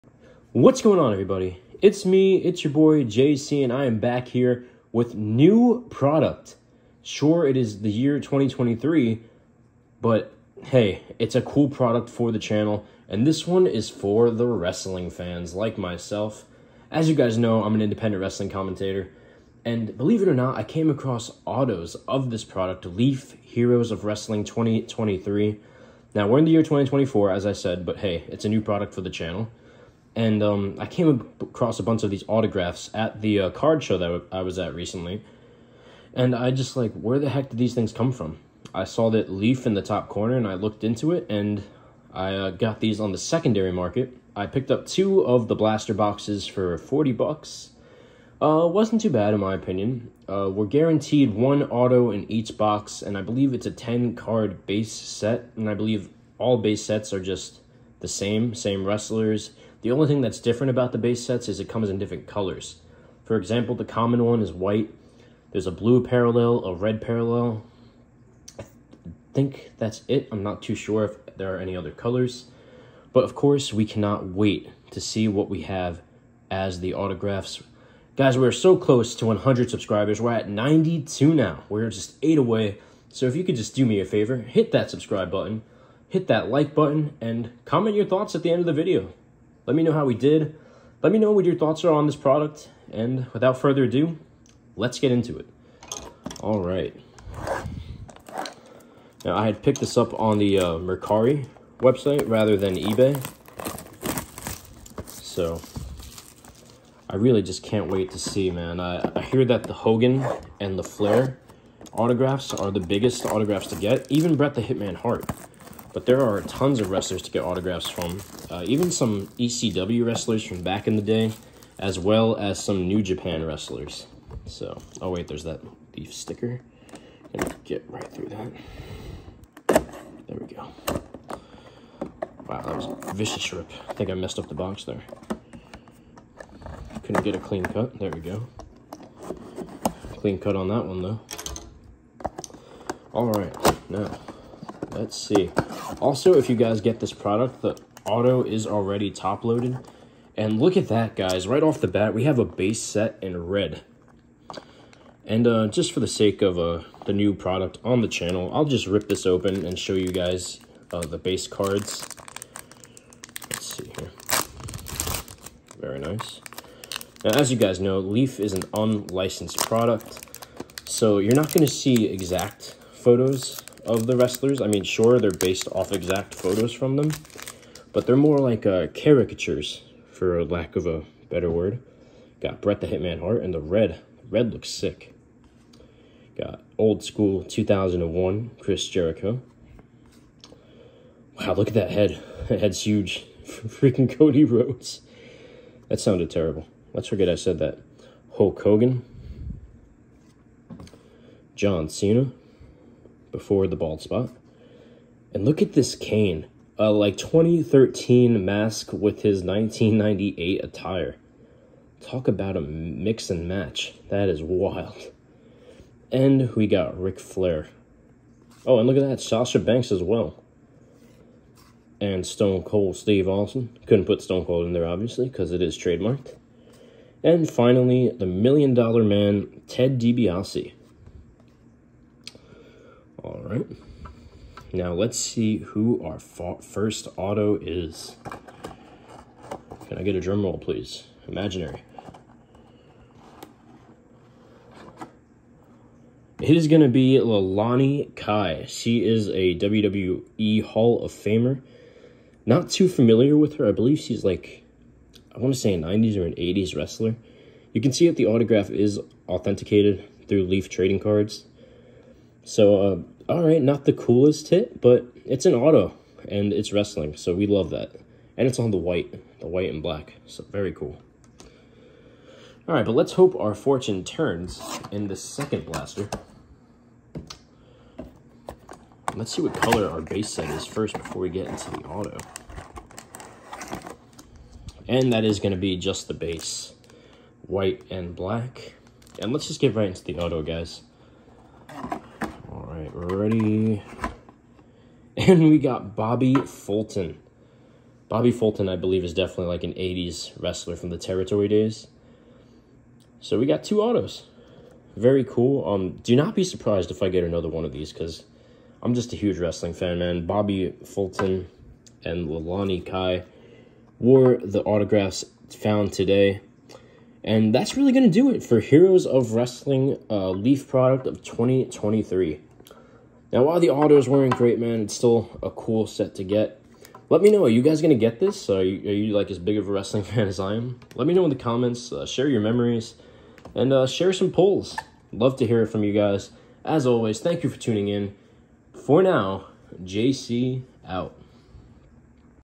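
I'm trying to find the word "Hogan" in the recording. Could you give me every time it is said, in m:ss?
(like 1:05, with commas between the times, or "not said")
1:49, 3:18.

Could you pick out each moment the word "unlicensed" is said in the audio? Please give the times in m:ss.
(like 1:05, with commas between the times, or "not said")
2:48.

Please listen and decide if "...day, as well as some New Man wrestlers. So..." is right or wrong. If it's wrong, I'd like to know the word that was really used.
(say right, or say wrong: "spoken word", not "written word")
wrong: "Japan", not "Man".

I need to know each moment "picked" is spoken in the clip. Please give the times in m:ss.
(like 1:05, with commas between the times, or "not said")
0:44, 1:39.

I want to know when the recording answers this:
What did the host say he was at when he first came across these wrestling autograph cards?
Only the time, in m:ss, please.
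0:33.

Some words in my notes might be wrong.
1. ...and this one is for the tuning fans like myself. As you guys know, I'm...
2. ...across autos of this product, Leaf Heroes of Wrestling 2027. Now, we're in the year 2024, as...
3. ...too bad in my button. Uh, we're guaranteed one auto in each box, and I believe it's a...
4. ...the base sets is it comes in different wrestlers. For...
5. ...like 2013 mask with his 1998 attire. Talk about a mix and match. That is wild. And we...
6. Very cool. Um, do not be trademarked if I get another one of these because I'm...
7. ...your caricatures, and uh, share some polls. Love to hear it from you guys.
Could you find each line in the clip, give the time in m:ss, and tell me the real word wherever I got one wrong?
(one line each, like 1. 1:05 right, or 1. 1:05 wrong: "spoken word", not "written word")
1. 0:13 wrong: "wrestling", not "tuning"
2. 0:20 wrong: "2023", not "2027"
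3. 0:49 wrong: "opinion", not "button"
4. 1:00 wrong: "colors", not "wrestlers"
5. 3:26 right
6. 5:04 wrong: "surprised", not "trademarked"
7. 5:32 wrong: "memories", not "caricatures".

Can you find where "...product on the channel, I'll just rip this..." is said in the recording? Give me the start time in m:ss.
2:37.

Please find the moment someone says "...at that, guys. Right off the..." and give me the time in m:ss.
2:30.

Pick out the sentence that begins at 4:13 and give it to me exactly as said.
I believe she's like, I want to say a 90s or an 80s wrestler.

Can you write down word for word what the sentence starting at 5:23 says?
Now, while the autos weren't great, man, it's still a cool set to get.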